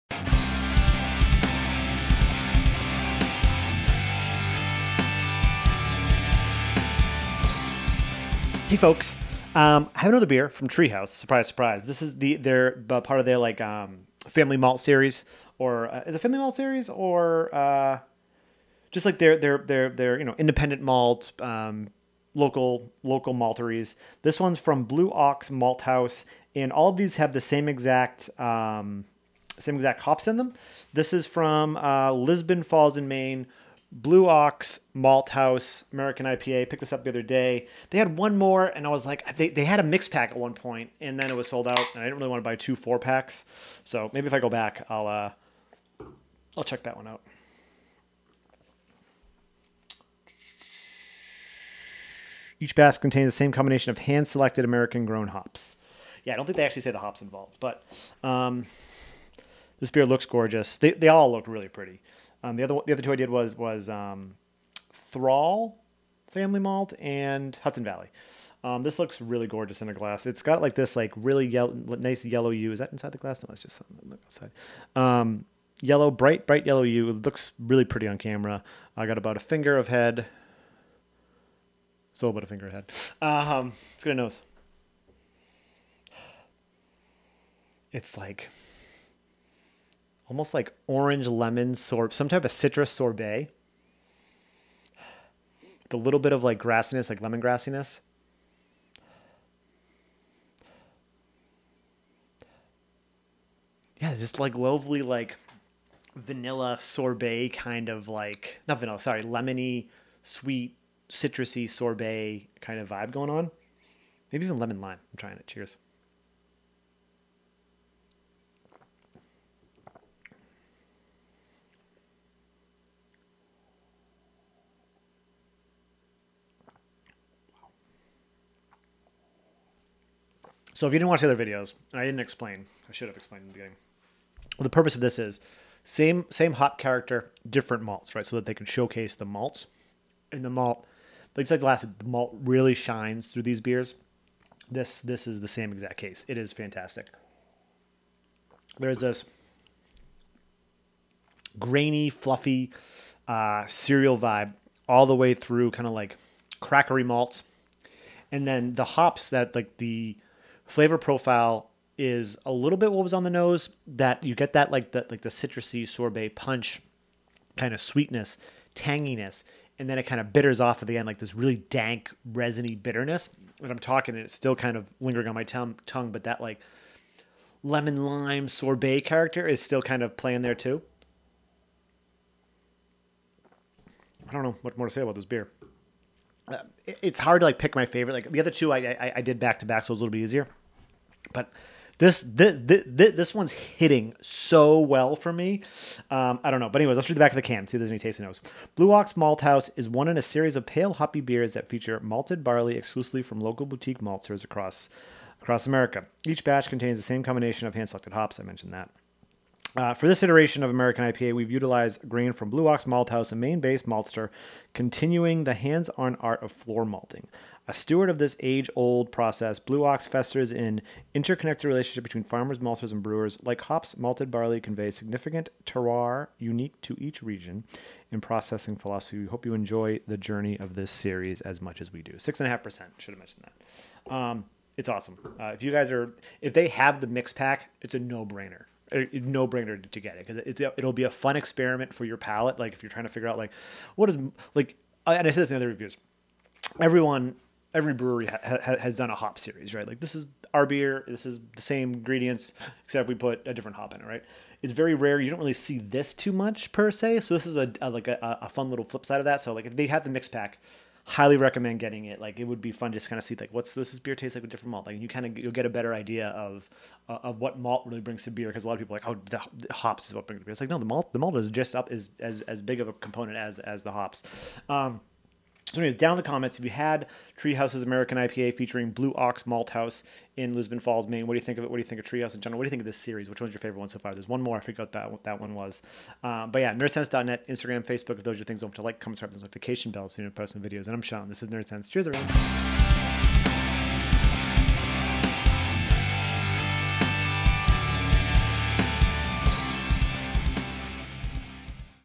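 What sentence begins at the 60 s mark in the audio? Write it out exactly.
They, they all look really pretty.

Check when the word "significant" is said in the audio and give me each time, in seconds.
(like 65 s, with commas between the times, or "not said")
224 s.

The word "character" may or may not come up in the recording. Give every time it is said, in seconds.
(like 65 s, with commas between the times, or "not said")
136 s, 179 s.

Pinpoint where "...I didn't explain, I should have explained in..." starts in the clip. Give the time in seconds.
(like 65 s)
131 s.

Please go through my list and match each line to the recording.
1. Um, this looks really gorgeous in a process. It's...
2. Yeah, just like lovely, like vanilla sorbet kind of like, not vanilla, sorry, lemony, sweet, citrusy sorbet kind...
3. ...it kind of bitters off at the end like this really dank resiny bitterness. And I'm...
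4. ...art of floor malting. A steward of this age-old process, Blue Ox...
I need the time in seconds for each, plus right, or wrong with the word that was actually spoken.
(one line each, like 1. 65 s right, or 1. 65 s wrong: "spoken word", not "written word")
1. 68 s wrong: "glass", not "process"
2. 104 s right
3. 169 s right
4. 216 s right.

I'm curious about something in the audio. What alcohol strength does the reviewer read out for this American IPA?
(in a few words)
6.5%.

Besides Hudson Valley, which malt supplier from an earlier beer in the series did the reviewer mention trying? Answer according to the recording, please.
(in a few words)
Thrall Family Malt.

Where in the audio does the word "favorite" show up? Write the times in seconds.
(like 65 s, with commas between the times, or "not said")
187 s, 283 s.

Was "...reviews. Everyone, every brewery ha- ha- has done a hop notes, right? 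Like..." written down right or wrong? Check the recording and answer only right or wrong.
wrong.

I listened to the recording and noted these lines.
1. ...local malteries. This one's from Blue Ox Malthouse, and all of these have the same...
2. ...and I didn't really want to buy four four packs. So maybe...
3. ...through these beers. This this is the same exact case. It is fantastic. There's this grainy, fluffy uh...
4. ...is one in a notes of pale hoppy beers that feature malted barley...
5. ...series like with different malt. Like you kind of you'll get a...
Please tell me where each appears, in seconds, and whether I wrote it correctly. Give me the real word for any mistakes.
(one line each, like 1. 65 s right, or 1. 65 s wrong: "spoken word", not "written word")
1. 23 s right
2. 41 s wrong: "two", not "four"
3. 143 s right
4. 199 s wrong: "series", not "notes"
5. 264 s wrong: "tastes", not "series".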